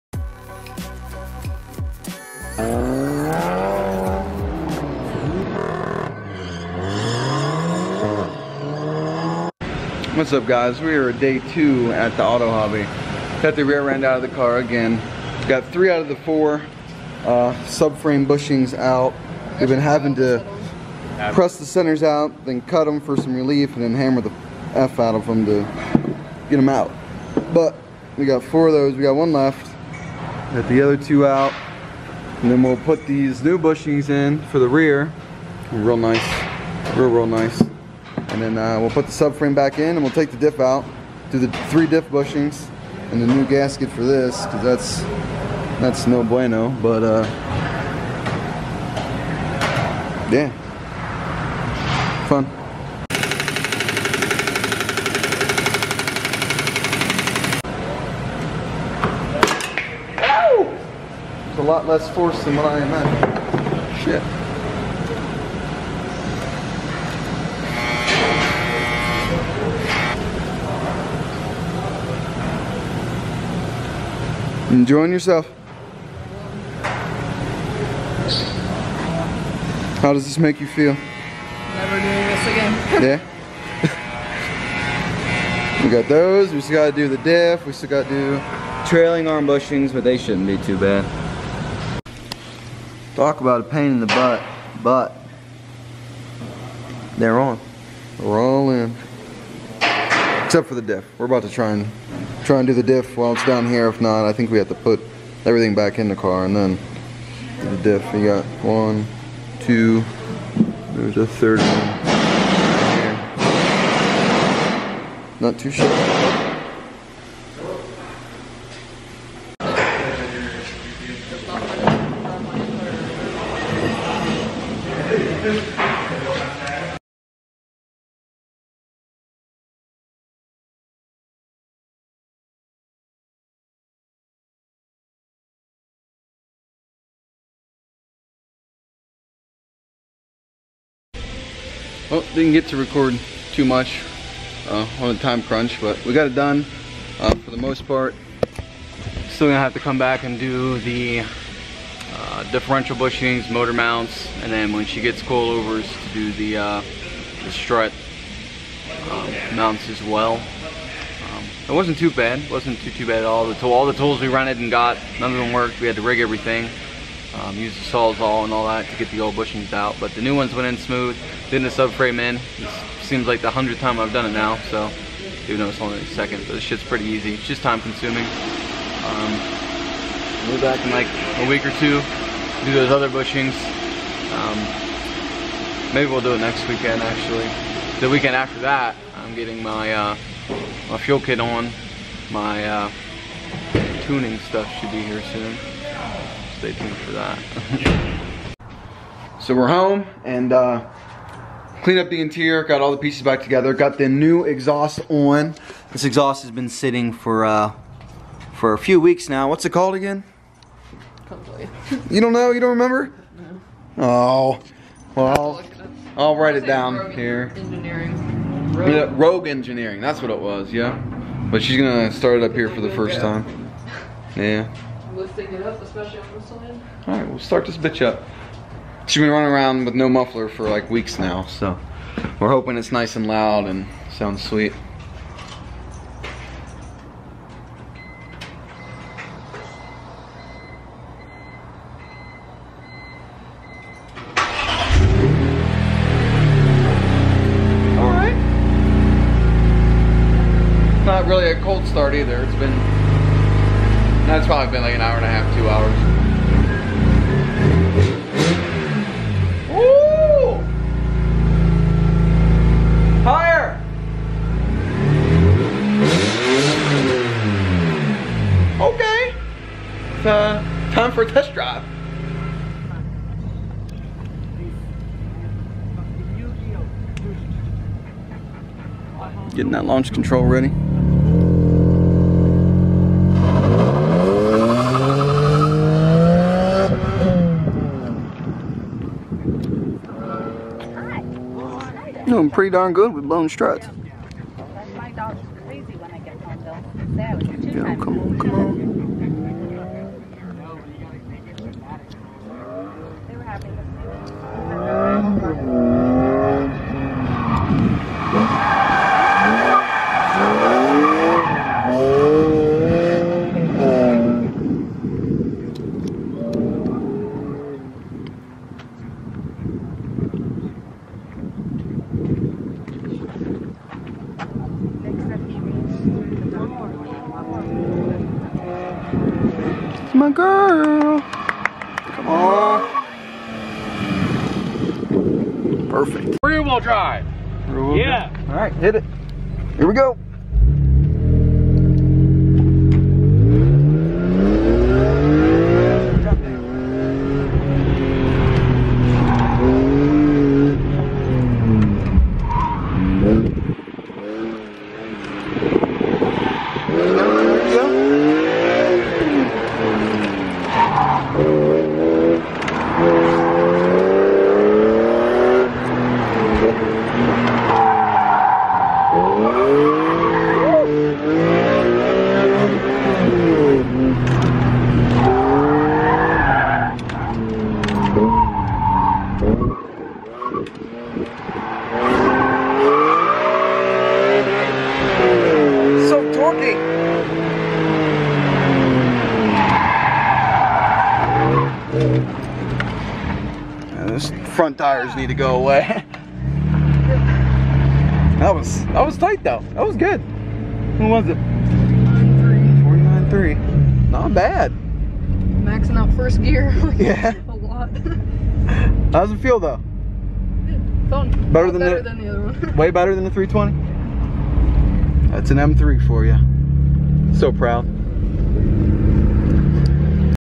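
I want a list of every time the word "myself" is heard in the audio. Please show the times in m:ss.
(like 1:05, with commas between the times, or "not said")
not said.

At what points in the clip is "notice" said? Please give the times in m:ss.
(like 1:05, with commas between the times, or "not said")
2:55.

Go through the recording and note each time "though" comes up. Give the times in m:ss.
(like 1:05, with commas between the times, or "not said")
6:39, 6:49.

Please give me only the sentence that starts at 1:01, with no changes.
lot less force than what I imagined.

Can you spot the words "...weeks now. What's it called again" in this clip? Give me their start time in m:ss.
3:29.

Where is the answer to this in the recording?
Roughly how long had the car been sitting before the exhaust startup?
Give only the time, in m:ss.
4:14.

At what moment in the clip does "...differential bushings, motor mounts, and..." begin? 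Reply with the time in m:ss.
2:32.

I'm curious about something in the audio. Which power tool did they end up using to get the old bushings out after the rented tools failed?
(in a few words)
Sawzall.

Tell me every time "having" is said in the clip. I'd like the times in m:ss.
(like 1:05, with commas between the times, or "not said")
0:19.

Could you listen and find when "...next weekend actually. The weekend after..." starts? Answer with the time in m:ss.
3:06.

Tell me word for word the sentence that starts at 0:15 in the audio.
Got three out of the four uh, subframe bushings out.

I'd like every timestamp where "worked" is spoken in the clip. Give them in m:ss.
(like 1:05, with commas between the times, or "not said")
2:45.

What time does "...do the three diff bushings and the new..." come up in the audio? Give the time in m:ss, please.
0:41.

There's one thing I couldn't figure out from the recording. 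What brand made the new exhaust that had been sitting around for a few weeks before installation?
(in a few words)
Rogue Engineering.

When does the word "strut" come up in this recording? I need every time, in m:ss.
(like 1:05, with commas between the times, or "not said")
2:37, 4:53.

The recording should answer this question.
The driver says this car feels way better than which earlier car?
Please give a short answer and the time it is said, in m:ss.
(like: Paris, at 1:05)
320, at 6:53.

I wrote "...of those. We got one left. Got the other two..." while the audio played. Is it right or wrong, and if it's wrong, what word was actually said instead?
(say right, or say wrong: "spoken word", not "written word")
right.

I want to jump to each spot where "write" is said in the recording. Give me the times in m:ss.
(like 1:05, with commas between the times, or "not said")
3:36.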